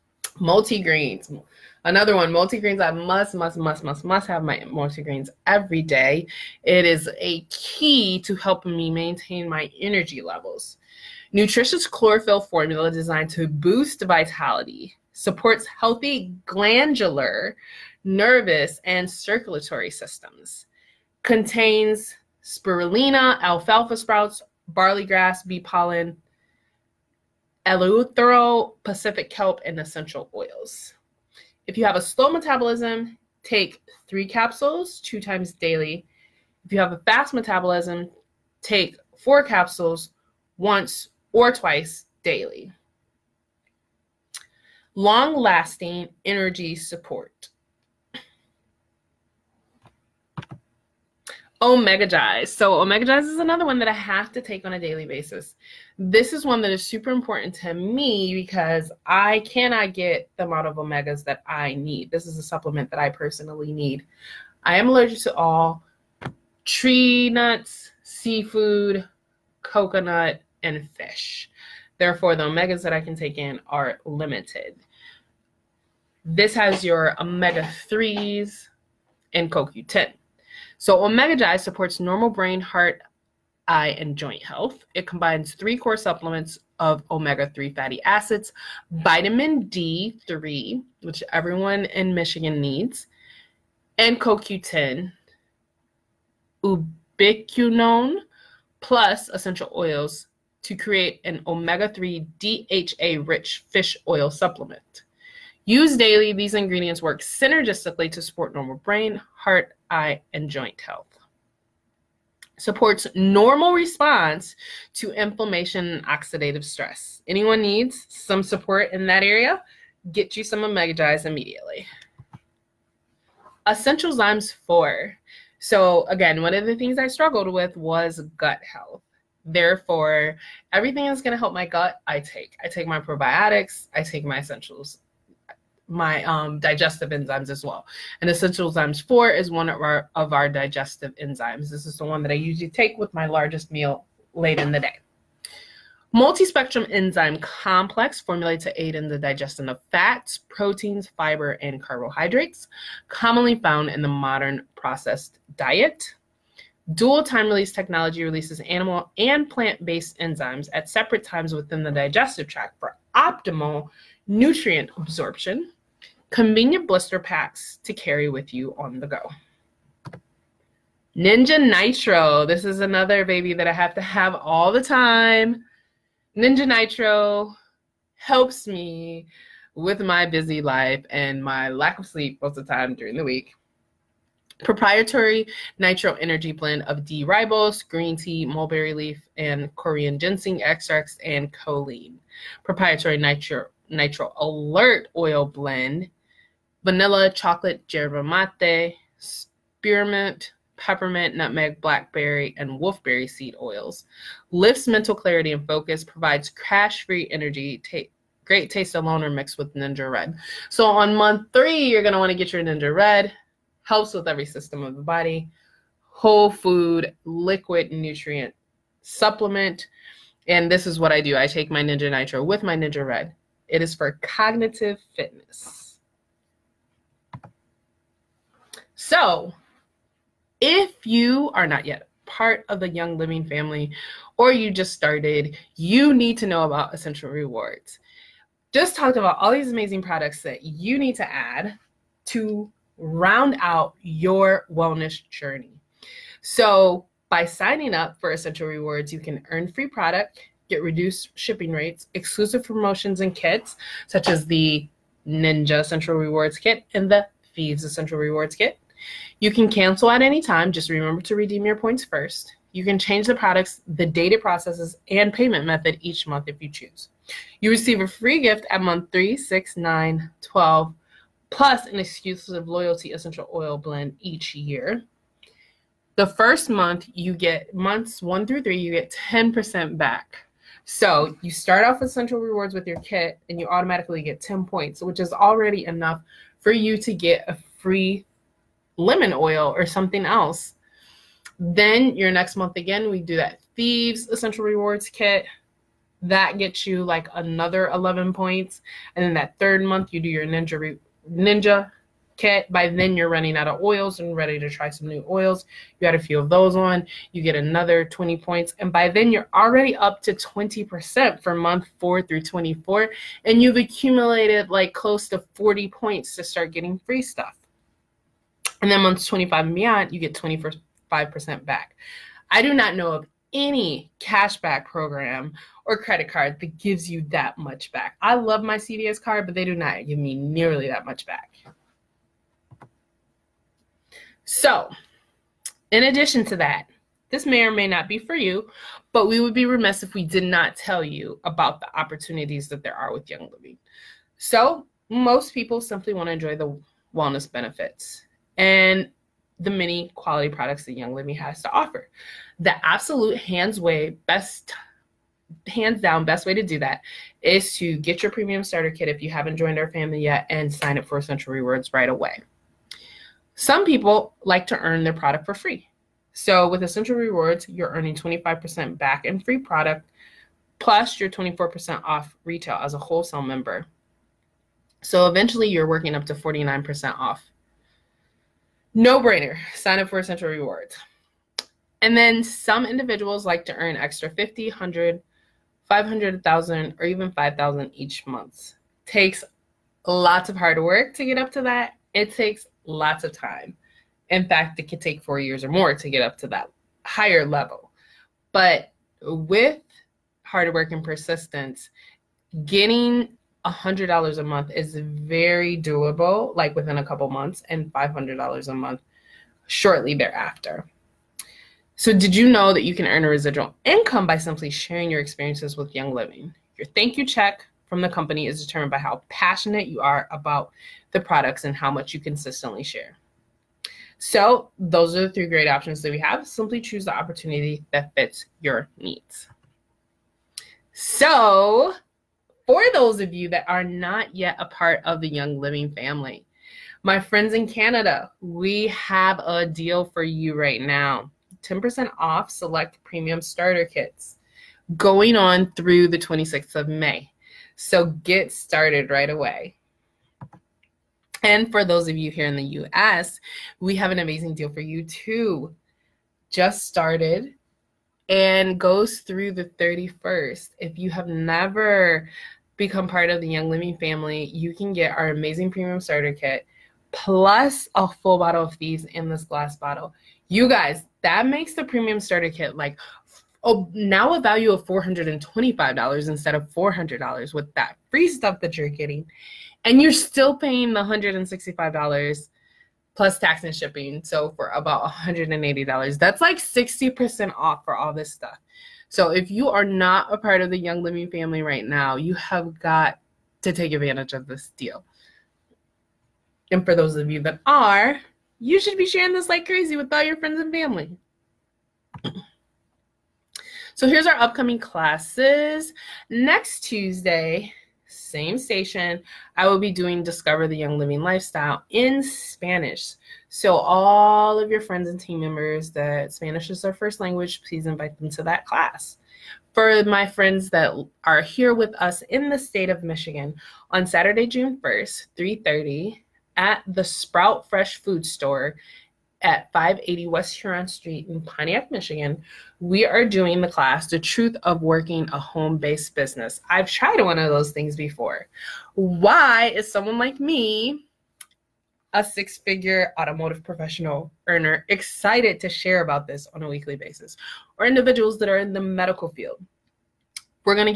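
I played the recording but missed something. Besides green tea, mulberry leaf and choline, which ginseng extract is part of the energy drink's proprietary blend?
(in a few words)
Korean ginseng.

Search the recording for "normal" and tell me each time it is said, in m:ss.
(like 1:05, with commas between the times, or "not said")
1:21, 1:48, 1:53.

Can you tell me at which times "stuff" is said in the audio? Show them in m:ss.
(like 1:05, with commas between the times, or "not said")
5:17, 7:58, 8:08.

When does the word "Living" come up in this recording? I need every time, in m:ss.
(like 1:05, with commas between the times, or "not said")
3:53, 5:43, 5:51, 6:56, 7:15, 7:43, 8:11, 8:30.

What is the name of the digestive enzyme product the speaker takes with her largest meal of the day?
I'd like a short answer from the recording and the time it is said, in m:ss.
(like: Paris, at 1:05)
Essential Zymes 4, at 2:03.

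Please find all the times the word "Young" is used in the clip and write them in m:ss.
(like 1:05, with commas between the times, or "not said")
3:52, 5:43, 5:50, 6:55, 7:15, 7:43, 8:10, 8:30.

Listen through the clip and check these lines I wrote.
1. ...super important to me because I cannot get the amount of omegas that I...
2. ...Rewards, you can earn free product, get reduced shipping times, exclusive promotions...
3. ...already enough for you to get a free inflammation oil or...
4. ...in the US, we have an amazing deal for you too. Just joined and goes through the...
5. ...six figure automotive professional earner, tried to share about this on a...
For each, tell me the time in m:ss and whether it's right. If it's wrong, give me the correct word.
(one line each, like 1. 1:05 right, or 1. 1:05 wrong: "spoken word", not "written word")
1. 0:56 right
2. 4:08 wrong: "rates", not "times"
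3. 4:45 wrong: "lemon", not "inflammation"
4. 7:32 wrong: "started", not "joined"
5. 9:02 wrong: "excited", not "tried".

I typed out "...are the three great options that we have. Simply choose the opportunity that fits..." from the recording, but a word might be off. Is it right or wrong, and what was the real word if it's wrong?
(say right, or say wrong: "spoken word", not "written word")
right.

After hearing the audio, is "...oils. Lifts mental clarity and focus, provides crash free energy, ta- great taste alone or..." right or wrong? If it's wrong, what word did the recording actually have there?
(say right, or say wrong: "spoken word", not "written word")
right.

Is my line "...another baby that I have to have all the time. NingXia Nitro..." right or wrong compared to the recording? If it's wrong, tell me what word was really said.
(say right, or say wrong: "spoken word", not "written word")
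right.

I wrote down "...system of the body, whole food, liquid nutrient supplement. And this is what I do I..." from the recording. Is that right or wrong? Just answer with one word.
right.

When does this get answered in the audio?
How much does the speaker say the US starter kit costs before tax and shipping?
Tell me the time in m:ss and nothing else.
8:01.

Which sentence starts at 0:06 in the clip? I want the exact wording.
It is a key to helping me maintain my energy levels.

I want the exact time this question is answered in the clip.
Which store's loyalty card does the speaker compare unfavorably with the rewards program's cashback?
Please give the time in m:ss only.
5:28.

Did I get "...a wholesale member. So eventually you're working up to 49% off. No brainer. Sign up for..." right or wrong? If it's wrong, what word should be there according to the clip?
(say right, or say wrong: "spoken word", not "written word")
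right.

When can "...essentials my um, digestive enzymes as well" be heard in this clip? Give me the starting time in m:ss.
2:14.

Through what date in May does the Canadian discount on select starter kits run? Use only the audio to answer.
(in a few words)
May 26.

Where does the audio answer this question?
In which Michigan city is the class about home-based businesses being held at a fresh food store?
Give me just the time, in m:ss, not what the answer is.
8:51.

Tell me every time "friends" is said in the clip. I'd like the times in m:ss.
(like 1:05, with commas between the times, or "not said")
7:17, 8:20, 8:34, 8:40.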